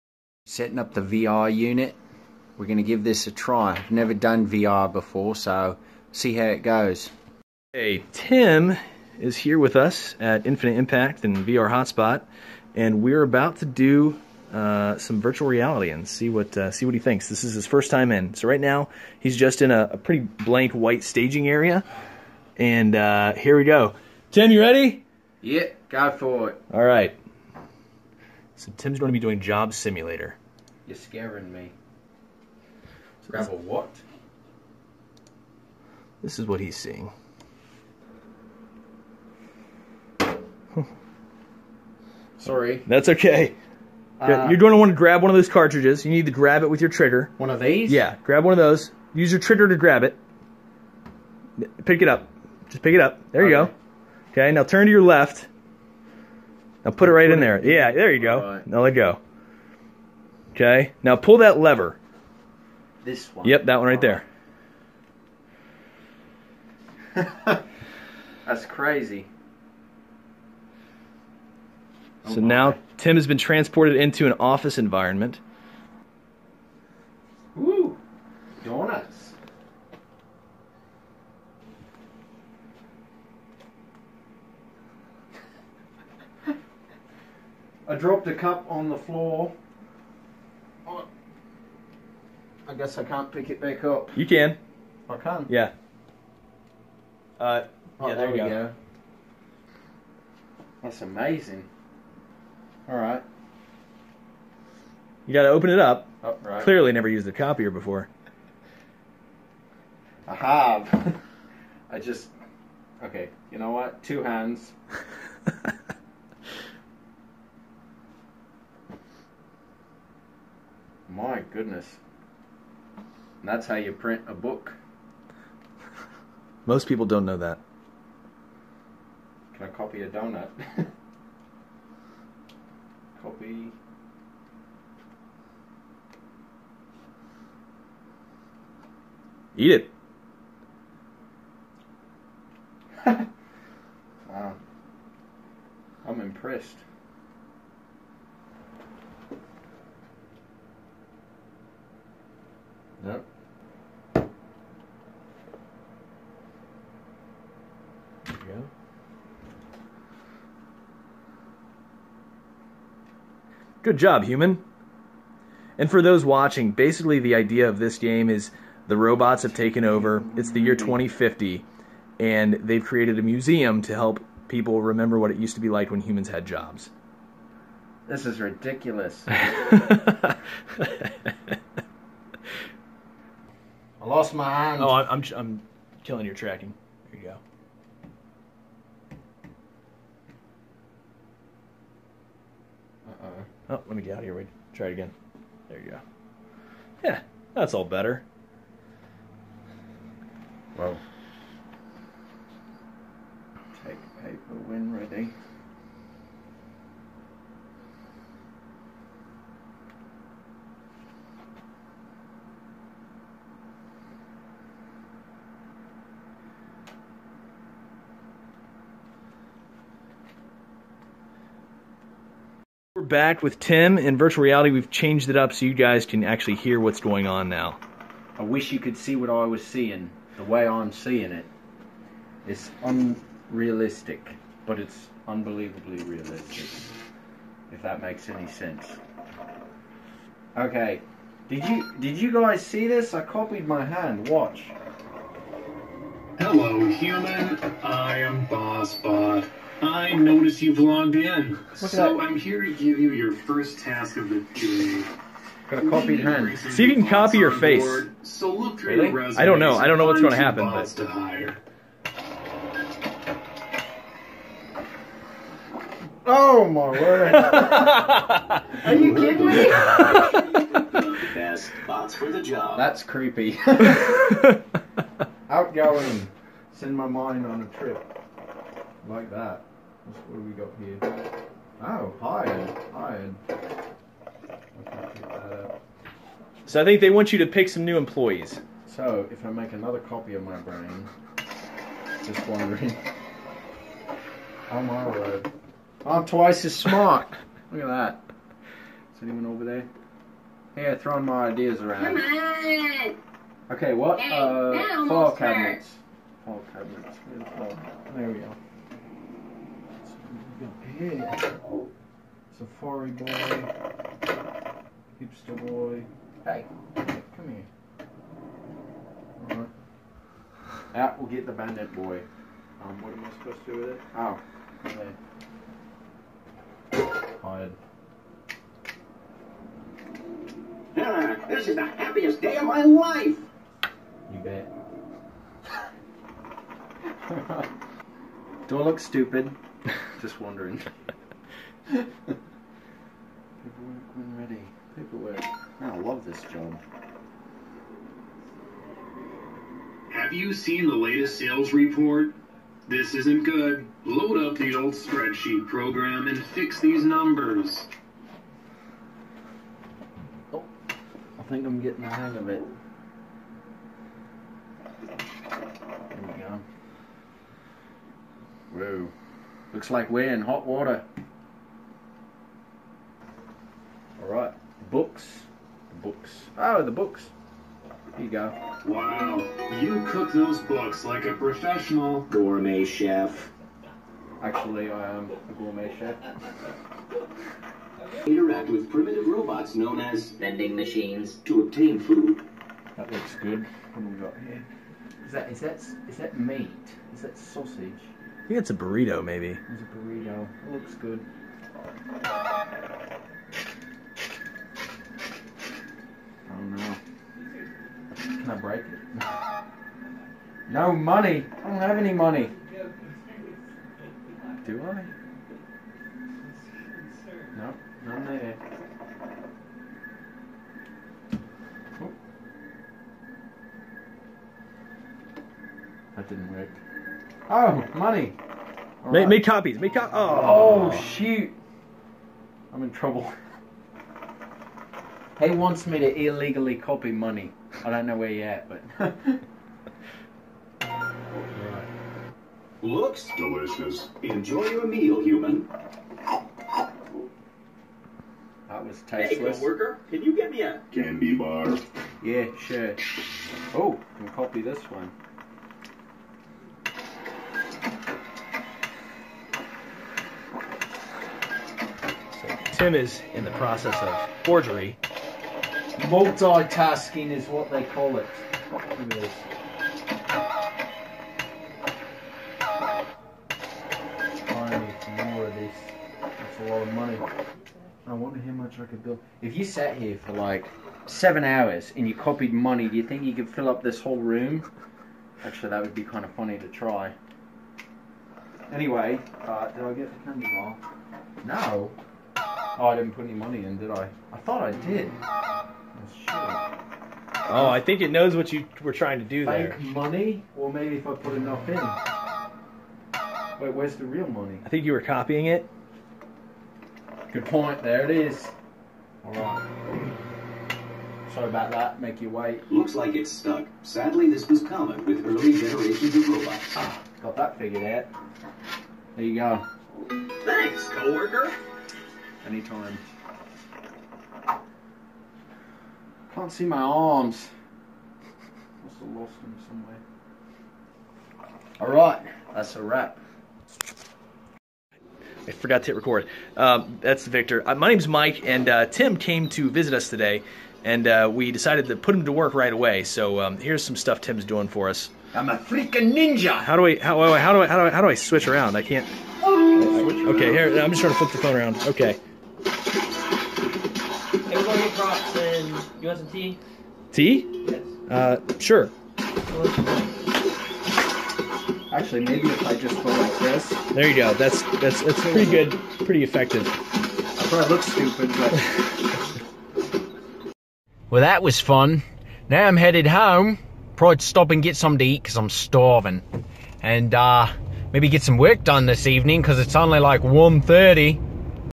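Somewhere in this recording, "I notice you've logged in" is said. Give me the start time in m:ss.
4:09.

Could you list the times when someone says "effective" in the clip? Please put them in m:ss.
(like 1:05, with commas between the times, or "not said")
9:26.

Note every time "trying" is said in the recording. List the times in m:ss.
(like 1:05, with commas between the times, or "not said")
8:18, 9:11.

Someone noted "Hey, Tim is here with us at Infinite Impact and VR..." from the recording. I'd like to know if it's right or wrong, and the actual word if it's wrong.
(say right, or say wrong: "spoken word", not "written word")
right.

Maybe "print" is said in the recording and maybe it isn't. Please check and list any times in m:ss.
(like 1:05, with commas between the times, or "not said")
2:03.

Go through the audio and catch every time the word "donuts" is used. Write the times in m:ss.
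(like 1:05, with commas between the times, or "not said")
1:18, 2:10.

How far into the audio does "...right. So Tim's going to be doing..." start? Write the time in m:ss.
0:26.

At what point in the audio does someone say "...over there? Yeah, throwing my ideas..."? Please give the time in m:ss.
4:59.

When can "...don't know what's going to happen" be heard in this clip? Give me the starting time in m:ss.
4:19.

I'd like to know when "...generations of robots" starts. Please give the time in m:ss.
8:35.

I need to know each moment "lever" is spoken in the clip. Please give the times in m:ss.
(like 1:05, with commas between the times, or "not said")
1:01.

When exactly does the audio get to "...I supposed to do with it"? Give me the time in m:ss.
5:23.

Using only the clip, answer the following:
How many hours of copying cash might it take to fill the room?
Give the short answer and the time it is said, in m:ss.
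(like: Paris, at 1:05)
7, at 8:01.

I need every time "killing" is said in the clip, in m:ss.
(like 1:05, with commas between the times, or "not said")
3:06.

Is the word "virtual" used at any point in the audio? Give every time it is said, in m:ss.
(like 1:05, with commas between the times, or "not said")
0:15, 3:44.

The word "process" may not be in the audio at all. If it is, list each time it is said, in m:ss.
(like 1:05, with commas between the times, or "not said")
7:43.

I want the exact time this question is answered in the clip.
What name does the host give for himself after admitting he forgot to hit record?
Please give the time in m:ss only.
8:58.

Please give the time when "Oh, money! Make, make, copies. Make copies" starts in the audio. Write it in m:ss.
7:07.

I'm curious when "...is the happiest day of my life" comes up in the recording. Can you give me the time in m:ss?
5:31.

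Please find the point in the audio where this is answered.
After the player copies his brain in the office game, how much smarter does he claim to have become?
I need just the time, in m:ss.
4:56.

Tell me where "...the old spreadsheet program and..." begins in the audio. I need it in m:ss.
5:54.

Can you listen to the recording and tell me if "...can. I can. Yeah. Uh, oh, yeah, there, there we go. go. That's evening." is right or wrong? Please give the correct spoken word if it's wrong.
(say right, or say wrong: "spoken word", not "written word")
wrong: "amazing", not "evening".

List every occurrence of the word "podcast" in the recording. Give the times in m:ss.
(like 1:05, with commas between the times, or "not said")
not said.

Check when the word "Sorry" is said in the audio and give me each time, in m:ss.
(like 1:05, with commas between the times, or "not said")
0:42, 8:31.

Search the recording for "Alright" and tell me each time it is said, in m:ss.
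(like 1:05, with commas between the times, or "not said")
5:19, 6:14, 8:51.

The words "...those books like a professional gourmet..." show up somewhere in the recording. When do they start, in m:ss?
6:20.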